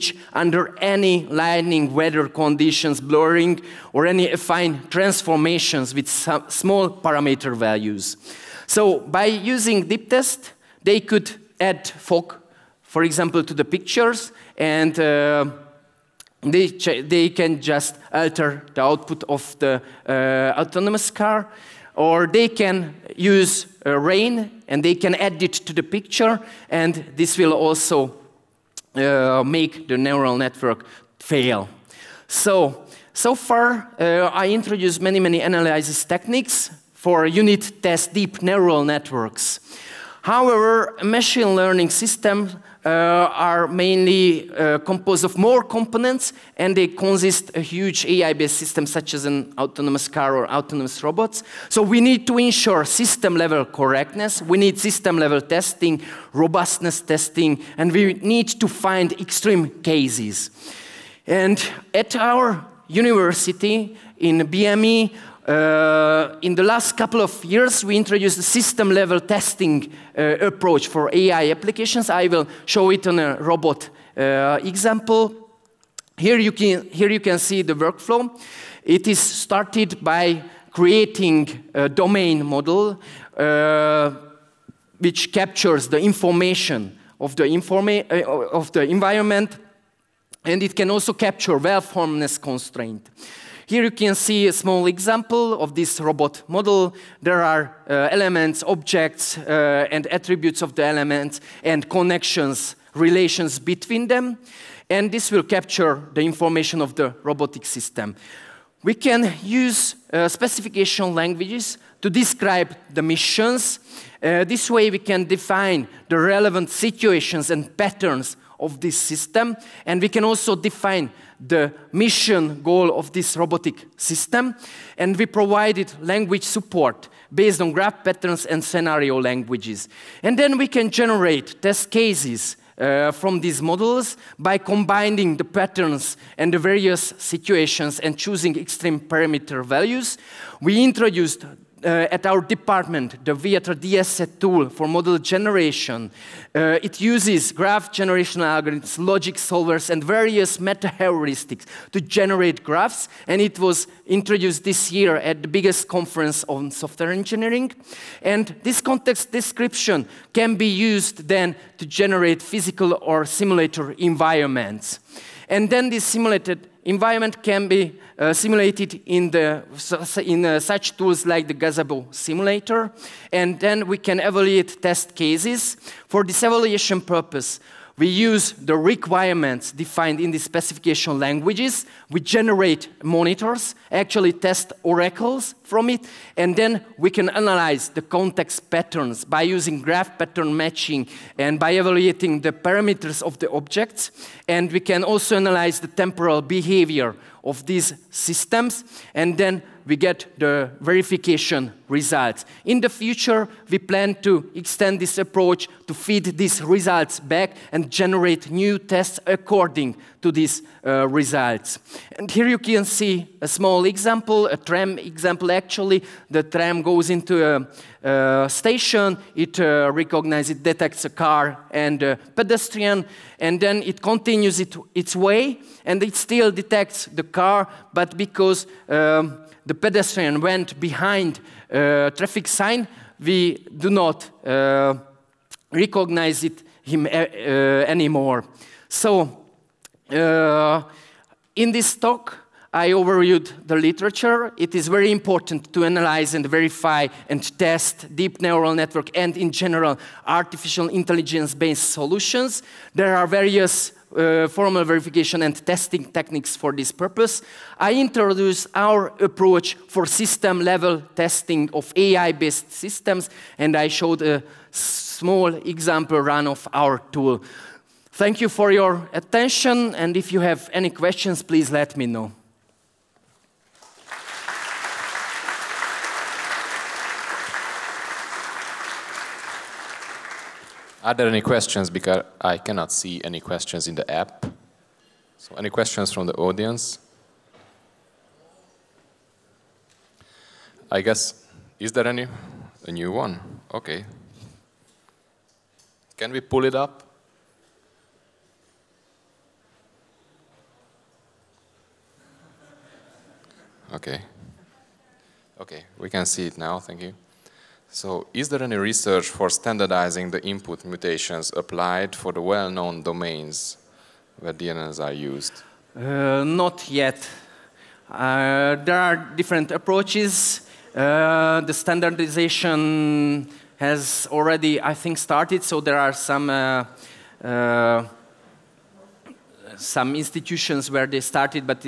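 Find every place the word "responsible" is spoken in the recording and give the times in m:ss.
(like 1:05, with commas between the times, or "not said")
not said.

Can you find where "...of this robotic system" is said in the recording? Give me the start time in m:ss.
2:02.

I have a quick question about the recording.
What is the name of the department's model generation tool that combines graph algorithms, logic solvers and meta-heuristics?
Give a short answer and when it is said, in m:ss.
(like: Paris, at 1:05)
Viatra DSET, at 2:23.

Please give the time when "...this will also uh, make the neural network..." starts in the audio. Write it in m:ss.
0:27.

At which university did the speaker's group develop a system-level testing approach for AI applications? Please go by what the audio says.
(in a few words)
BME.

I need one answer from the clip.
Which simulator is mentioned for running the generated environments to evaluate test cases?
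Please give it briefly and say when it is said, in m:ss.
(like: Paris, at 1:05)
Gazebo, at 2:51.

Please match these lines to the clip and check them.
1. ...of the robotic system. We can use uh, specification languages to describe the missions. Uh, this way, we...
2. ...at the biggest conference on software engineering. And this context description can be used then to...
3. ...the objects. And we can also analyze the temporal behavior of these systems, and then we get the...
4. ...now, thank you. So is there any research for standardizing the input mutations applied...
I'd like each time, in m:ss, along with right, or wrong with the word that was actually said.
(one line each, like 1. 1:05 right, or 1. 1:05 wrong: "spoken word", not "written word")
1. 1:46 right
2. 2:35 right
3. 3:13 right
4. 5:06 right.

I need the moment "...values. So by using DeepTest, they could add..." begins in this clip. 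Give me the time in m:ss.
0:07.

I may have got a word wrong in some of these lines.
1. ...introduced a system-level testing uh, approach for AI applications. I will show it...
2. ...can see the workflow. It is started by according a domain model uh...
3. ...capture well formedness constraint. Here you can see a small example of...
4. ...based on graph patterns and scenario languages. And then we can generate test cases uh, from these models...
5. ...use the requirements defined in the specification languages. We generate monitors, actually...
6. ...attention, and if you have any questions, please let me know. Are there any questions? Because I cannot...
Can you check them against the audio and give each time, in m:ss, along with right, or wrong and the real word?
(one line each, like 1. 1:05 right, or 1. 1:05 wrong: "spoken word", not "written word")
1. 1:07 right
2. 1:17 wrong: "creating", not "according"
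3. 1:31 right
4. 2:07 right
5. 2:58 right
6. 4:29 right.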